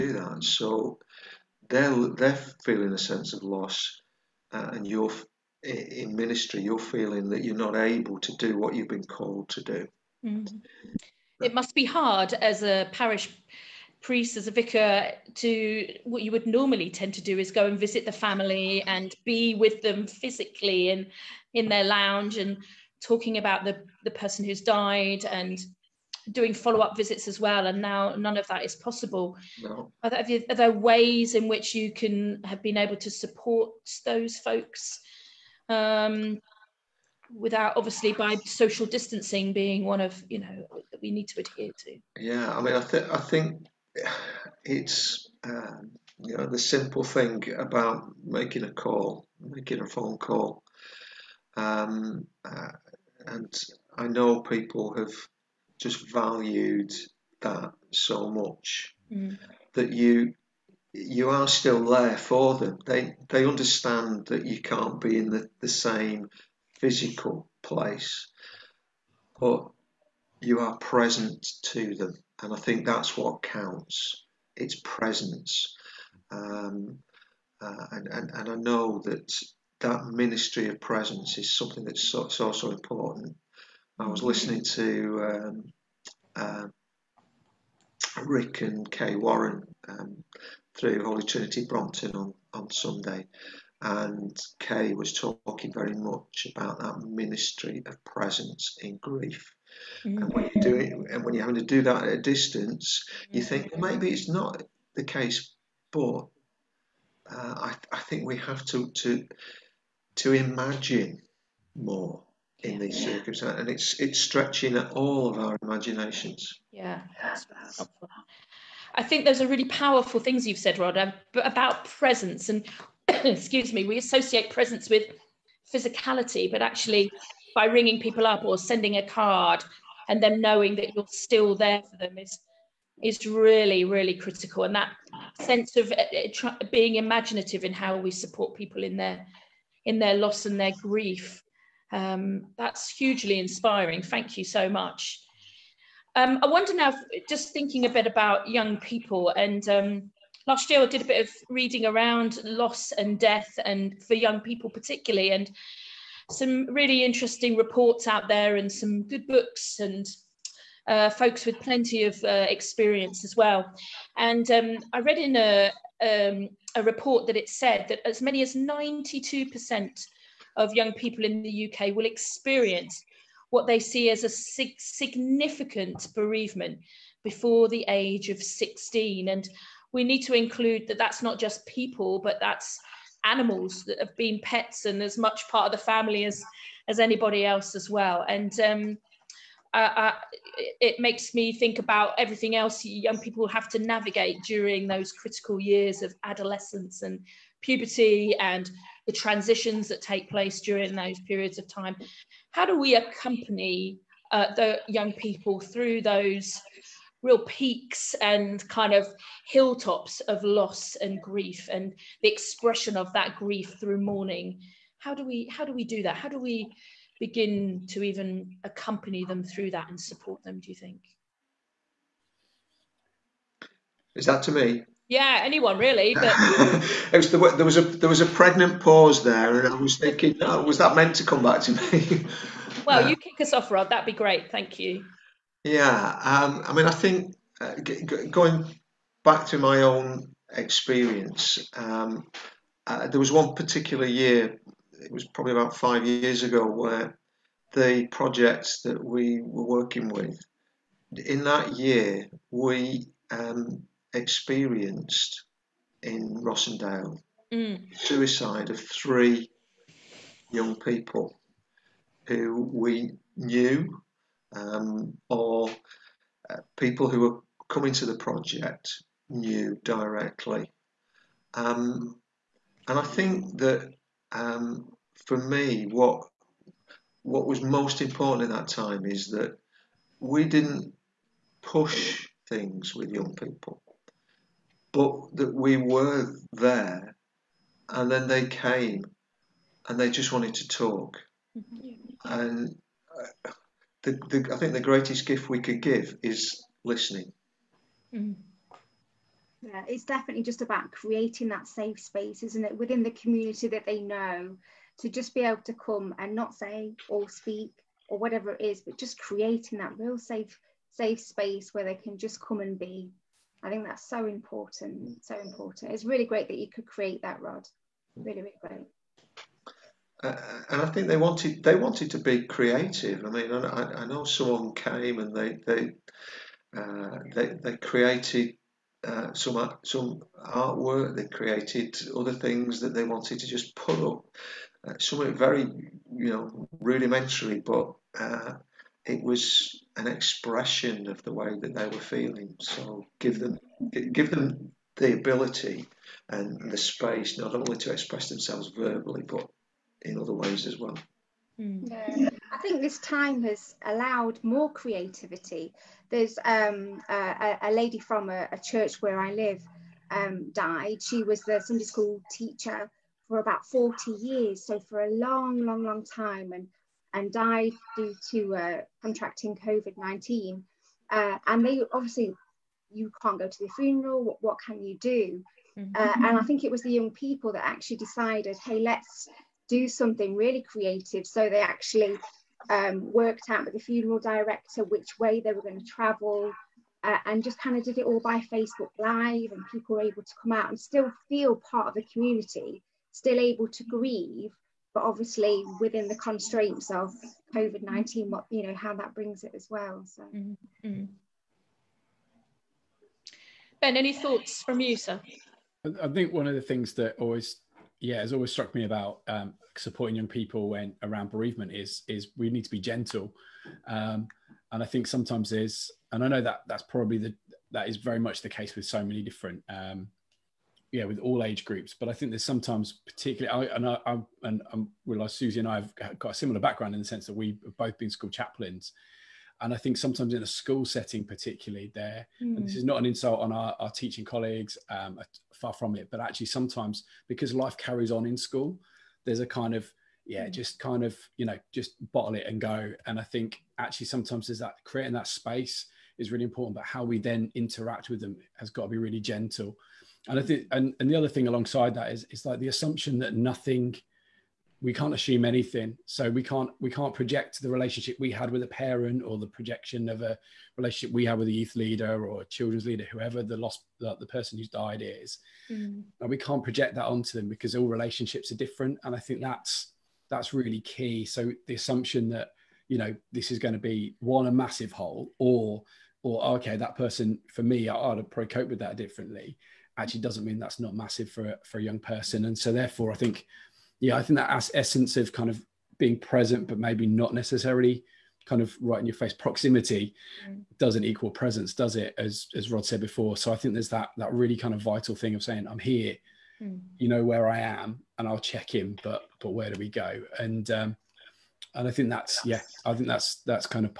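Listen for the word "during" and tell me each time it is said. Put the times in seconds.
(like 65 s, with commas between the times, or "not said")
194 s, 200 s.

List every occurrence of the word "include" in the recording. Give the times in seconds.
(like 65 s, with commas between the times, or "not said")
180 s.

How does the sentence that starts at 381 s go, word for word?
So they actually um, worked out with the funeral director which way they were going to travel.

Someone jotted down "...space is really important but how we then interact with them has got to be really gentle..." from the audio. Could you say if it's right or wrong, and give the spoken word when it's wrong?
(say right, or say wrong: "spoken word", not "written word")
right.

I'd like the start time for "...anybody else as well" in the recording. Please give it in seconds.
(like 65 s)
186 s.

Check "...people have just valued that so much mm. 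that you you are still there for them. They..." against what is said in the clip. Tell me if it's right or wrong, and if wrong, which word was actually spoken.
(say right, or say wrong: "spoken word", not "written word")
right.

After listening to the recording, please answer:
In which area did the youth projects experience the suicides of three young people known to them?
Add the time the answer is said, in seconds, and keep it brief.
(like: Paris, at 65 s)
Rossendale, at 256 s.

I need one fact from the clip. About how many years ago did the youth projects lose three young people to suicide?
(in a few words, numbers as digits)
5 years.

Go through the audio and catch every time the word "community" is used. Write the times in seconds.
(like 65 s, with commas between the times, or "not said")
303 s, 392 s.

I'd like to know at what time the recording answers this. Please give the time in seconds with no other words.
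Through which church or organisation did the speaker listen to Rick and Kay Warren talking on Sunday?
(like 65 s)
91 s.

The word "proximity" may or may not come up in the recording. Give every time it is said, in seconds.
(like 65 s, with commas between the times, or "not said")
489 s.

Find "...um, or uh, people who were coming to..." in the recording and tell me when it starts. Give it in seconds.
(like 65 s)
264 s.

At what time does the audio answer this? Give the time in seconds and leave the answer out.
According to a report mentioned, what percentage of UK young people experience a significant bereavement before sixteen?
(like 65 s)
168 s.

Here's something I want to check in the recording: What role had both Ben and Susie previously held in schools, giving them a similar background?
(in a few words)
School chaplains.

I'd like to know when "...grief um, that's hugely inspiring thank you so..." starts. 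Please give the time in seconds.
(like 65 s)
140 s.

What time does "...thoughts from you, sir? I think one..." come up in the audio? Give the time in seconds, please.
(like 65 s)
404 s.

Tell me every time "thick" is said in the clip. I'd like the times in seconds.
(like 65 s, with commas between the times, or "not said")
not said.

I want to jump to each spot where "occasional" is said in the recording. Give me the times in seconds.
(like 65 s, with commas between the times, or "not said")
not said.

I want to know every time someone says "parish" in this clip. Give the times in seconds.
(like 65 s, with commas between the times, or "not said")
12 s.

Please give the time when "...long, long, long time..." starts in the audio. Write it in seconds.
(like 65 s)
365 s.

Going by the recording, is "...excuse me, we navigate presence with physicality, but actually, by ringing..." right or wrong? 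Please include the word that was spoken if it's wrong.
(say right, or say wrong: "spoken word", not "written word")
wrong: "associate", not "navigate".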